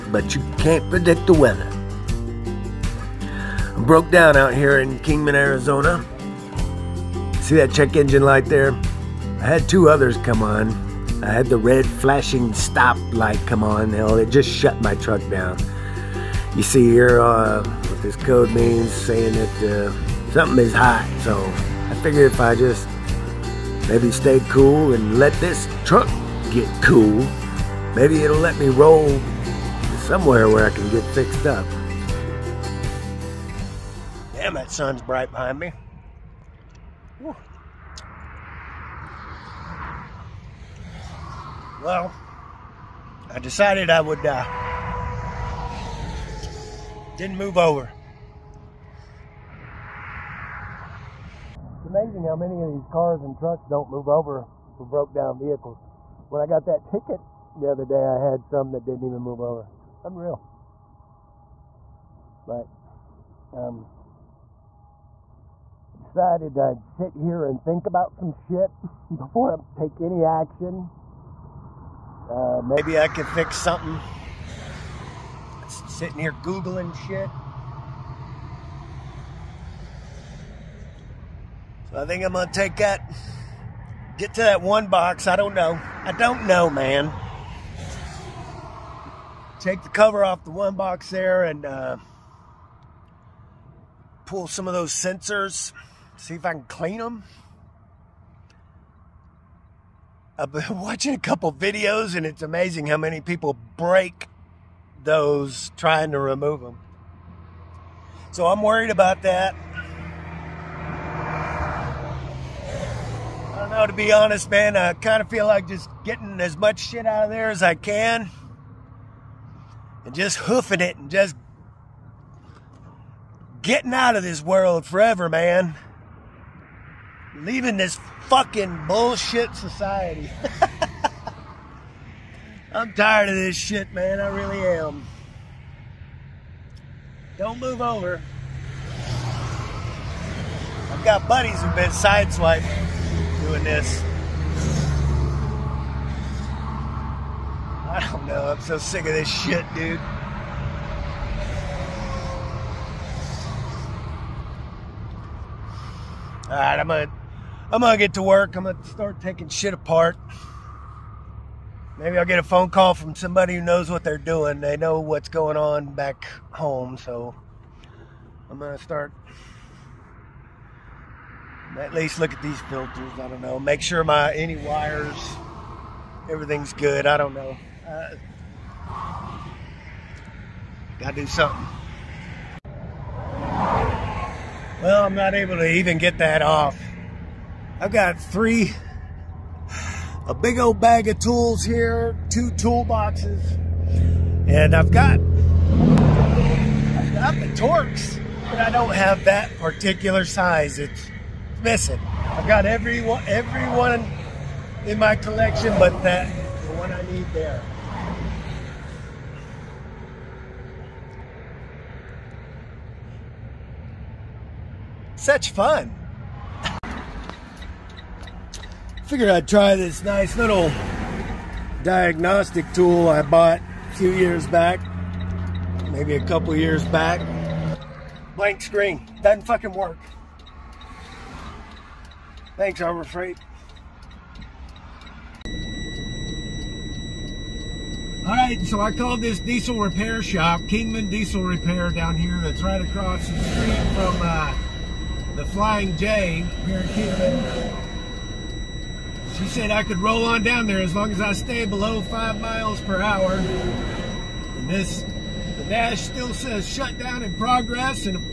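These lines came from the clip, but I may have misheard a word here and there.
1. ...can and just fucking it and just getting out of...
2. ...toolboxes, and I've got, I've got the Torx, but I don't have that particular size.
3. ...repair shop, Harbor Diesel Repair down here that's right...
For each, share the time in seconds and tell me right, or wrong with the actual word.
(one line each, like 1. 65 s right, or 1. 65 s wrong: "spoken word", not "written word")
1. 117 s wrong: "hoofing", not "fucking"
2. 192 s right
3. 239 s wrong: "Kingman", not "Harbor".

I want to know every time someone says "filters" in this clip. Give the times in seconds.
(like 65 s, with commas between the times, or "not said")
172 s.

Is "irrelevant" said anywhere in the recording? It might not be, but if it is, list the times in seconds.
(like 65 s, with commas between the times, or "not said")
not said.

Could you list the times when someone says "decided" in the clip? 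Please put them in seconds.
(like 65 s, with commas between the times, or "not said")
43 s, 65 s.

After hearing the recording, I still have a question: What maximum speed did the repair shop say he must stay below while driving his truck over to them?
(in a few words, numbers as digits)
5 miles per hour.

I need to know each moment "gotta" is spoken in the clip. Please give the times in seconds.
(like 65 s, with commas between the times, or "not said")
180 s.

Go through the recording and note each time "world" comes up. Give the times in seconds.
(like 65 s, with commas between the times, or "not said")
124 s.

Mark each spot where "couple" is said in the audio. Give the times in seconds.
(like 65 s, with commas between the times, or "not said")
101 s, 226 s.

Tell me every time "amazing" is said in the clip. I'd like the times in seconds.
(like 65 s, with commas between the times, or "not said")
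51 s, 102 s.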